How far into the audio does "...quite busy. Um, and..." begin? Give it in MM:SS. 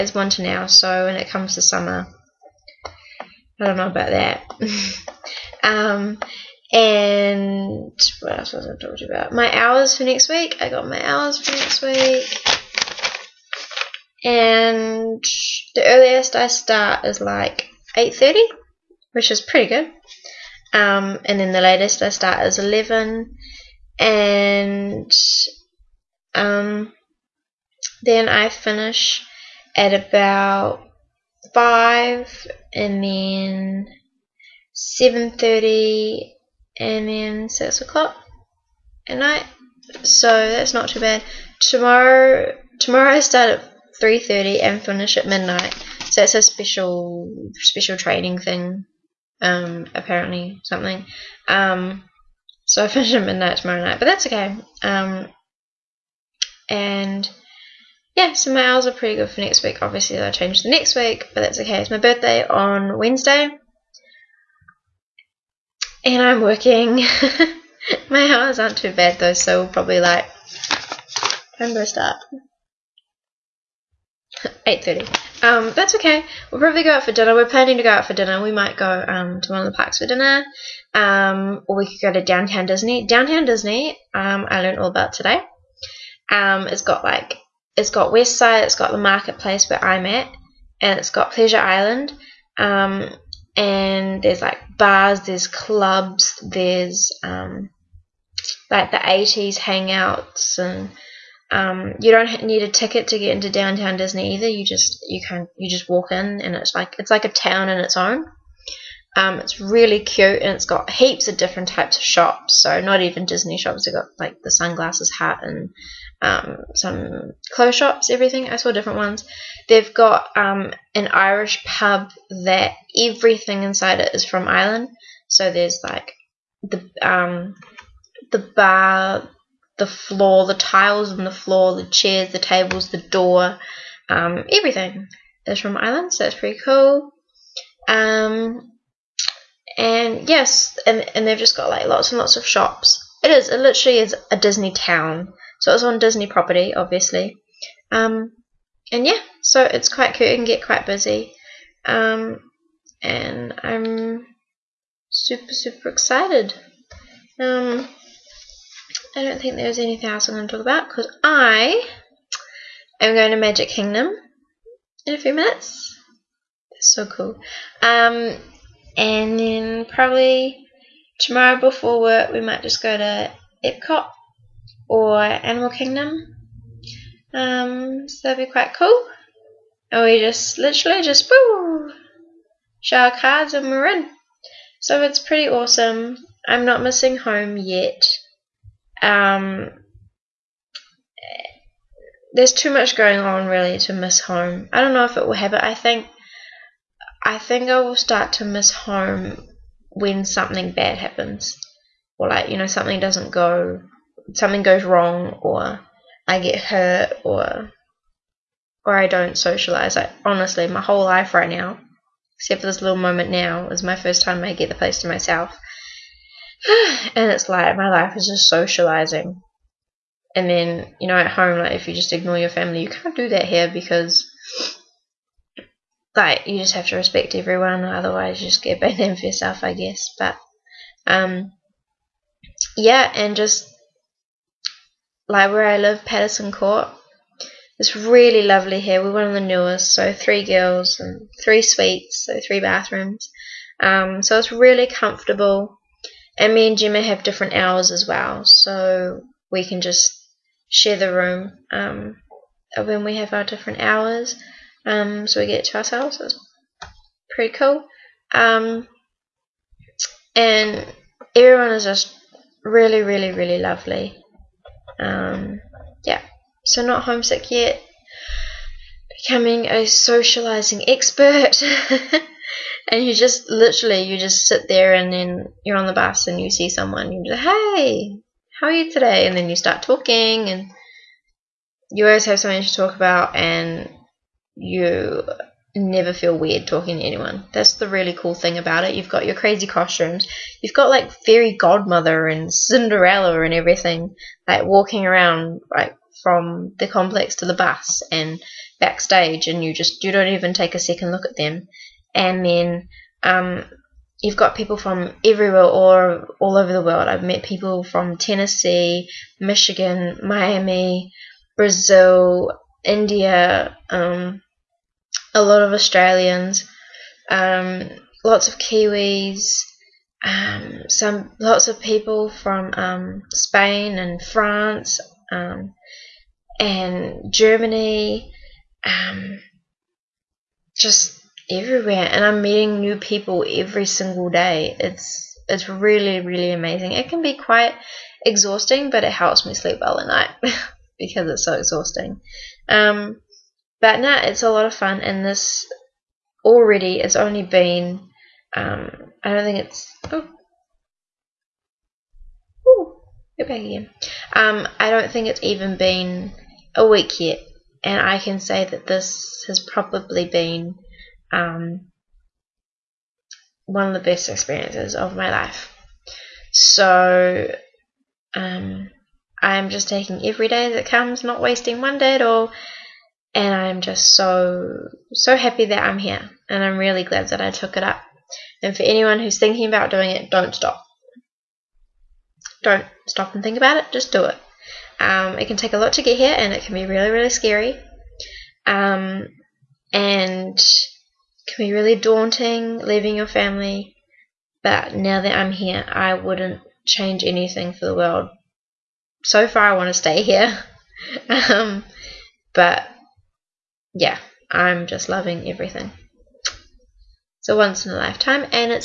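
02:30.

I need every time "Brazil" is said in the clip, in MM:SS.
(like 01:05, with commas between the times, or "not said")
05:11.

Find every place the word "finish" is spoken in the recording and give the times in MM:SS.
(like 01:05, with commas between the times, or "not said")
00:28, 00:44, 00:52.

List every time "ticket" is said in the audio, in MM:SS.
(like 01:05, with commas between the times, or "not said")
01:42.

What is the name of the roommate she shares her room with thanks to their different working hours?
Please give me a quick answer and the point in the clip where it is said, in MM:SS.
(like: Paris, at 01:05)
Gemma, at 04:06.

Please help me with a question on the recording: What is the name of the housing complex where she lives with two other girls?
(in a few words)
Patterson Court.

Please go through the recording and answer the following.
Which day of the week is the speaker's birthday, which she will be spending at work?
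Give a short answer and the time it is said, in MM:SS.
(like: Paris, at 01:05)
Wednesday, at 01:02.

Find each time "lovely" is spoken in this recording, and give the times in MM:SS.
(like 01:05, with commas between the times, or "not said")
03:58, 04:23.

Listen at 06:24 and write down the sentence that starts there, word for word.
Um, it can take a lot to get here and it can be really, really scary.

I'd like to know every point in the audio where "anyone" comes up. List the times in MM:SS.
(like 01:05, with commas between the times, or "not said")
04:47, 06:18.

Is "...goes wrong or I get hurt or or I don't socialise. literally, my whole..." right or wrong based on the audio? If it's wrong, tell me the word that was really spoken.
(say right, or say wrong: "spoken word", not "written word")
wrong: "honestly", not "literally".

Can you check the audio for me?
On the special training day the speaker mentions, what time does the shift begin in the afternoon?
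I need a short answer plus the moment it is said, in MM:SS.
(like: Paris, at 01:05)
3:30, at 00:44.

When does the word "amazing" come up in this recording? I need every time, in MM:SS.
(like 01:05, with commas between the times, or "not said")
05:36.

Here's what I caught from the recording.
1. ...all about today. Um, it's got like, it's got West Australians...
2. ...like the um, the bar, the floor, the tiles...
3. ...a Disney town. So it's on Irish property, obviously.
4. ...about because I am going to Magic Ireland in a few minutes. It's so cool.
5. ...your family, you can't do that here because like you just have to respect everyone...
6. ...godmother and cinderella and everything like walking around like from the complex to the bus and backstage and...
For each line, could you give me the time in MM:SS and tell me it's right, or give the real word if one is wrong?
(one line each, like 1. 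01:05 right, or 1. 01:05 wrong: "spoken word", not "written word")
1. 01:24 wrong: "Side", not "Australians"
2. 02:05 right
3. 02:24 wrong: "Disney", not "Irish"
4. 02:40 wrong: "Kingdom", not "Ireland"
5. 03:42 right
6. 04:51 right.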